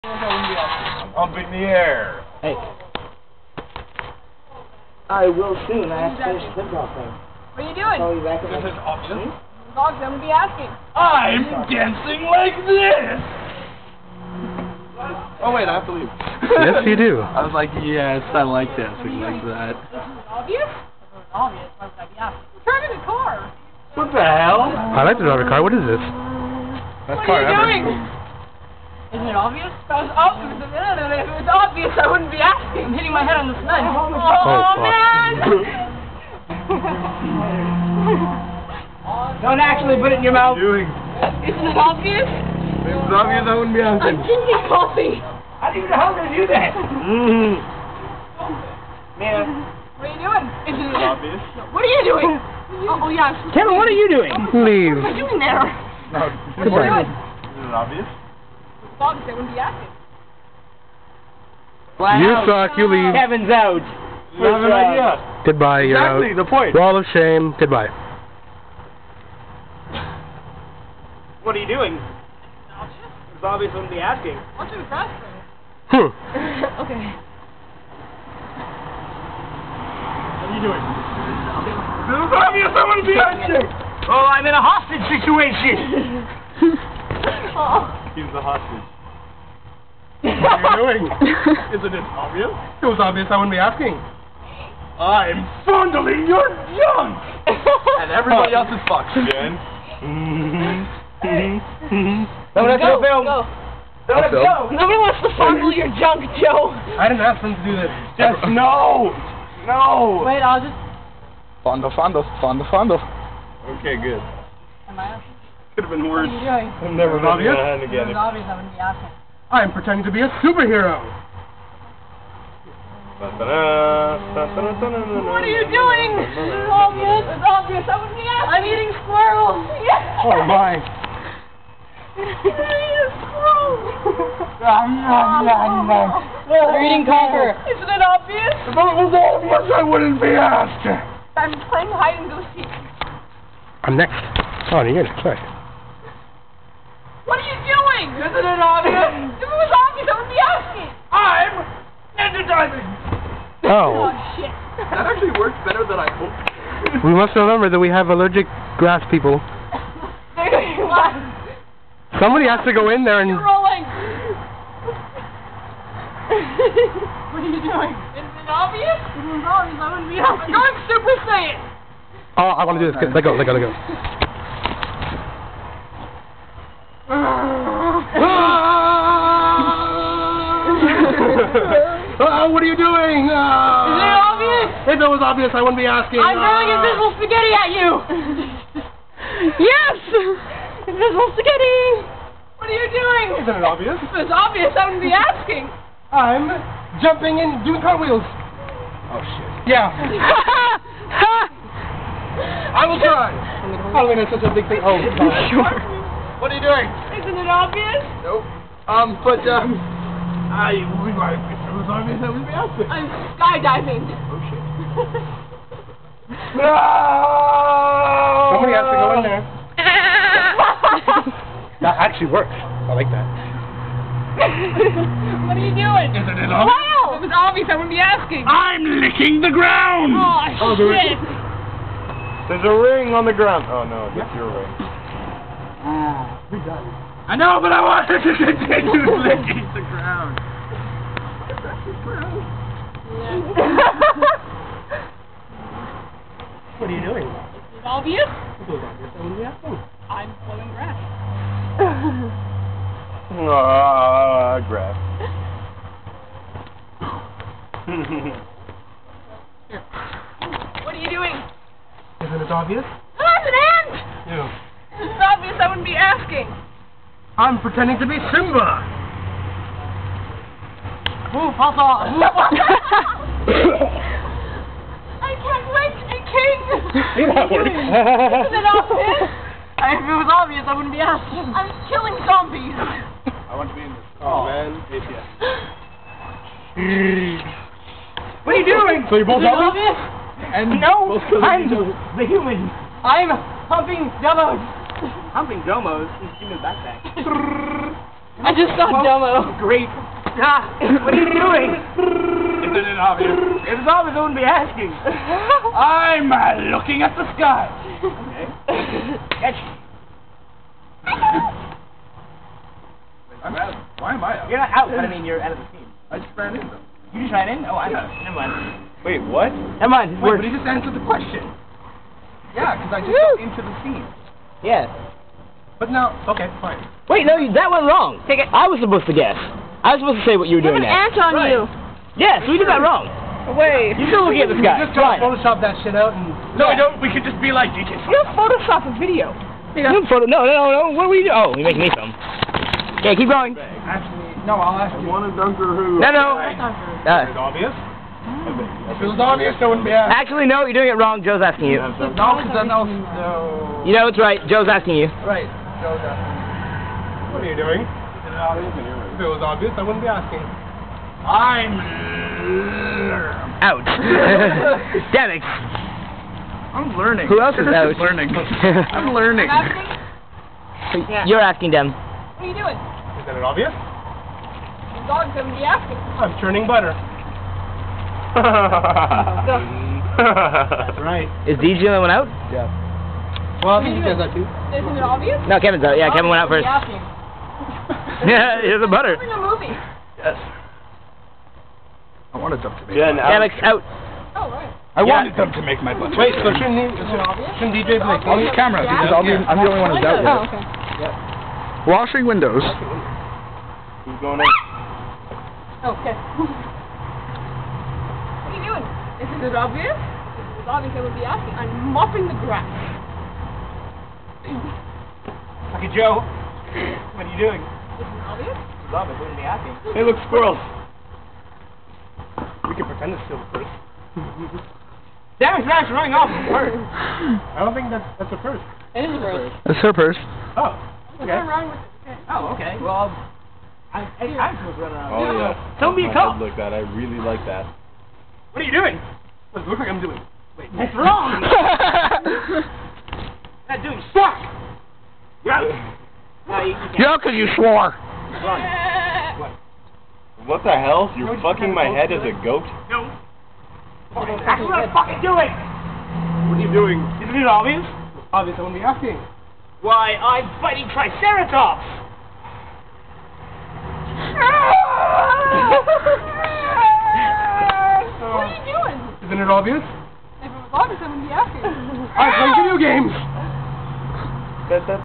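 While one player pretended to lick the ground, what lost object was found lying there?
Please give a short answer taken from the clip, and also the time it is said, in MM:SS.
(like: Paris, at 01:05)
A ring, at 03:52.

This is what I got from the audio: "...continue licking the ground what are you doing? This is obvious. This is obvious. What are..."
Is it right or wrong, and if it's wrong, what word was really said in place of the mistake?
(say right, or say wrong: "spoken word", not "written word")
right.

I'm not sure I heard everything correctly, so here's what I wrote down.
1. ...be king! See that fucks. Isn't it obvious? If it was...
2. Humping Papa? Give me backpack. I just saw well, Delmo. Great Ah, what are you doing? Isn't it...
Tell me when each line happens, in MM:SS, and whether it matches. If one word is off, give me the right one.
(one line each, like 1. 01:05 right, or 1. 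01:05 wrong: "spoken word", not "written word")
1. 04:36 wrong: "works", not "fucks"
2. 04:55 wrong: "Delmos", not "Papa".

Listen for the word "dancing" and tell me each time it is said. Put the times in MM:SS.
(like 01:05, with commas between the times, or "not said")
00:11, 00:18.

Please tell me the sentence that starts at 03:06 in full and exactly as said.
I'm throwing uh, invisible spaghetti at you.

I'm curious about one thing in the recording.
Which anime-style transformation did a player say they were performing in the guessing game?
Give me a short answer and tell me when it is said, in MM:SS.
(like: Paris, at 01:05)
Super Saiyan, at 02:50.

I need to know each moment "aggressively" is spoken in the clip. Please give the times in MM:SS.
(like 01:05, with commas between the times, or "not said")
not said.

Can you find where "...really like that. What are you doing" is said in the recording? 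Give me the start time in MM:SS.
07:16.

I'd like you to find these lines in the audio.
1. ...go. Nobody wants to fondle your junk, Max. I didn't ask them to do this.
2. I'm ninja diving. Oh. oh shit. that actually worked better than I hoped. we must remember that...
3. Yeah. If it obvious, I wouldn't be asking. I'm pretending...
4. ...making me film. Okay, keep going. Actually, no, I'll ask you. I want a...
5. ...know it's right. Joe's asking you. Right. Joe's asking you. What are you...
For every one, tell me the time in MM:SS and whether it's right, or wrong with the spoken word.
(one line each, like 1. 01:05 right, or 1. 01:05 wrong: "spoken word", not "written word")
1. 01:44 wrong: "Joe", not "Max"
2. 02:31 right
3. 04:24 right
4. 05:41 right
5. 05:53 right.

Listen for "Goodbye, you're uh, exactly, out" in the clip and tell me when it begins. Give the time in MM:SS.
01:05.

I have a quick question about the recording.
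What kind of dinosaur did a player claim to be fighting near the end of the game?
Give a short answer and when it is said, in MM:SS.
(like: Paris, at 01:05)
Triceratops, at 07:40.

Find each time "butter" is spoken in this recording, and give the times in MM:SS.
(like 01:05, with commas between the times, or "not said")
06:16, 06:28, 06:35.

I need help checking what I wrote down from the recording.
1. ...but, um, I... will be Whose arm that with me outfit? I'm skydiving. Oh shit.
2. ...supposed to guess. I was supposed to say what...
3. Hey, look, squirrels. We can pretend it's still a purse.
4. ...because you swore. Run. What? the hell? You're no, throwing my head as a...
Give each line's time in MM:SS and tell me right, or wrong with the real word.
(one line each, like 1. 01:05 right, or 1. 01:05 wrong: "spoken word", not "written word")
1. 03:29 right
2. 05:28 right
3. 06:59 right
4. 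07:27 wrong: "fucking", not "throwing".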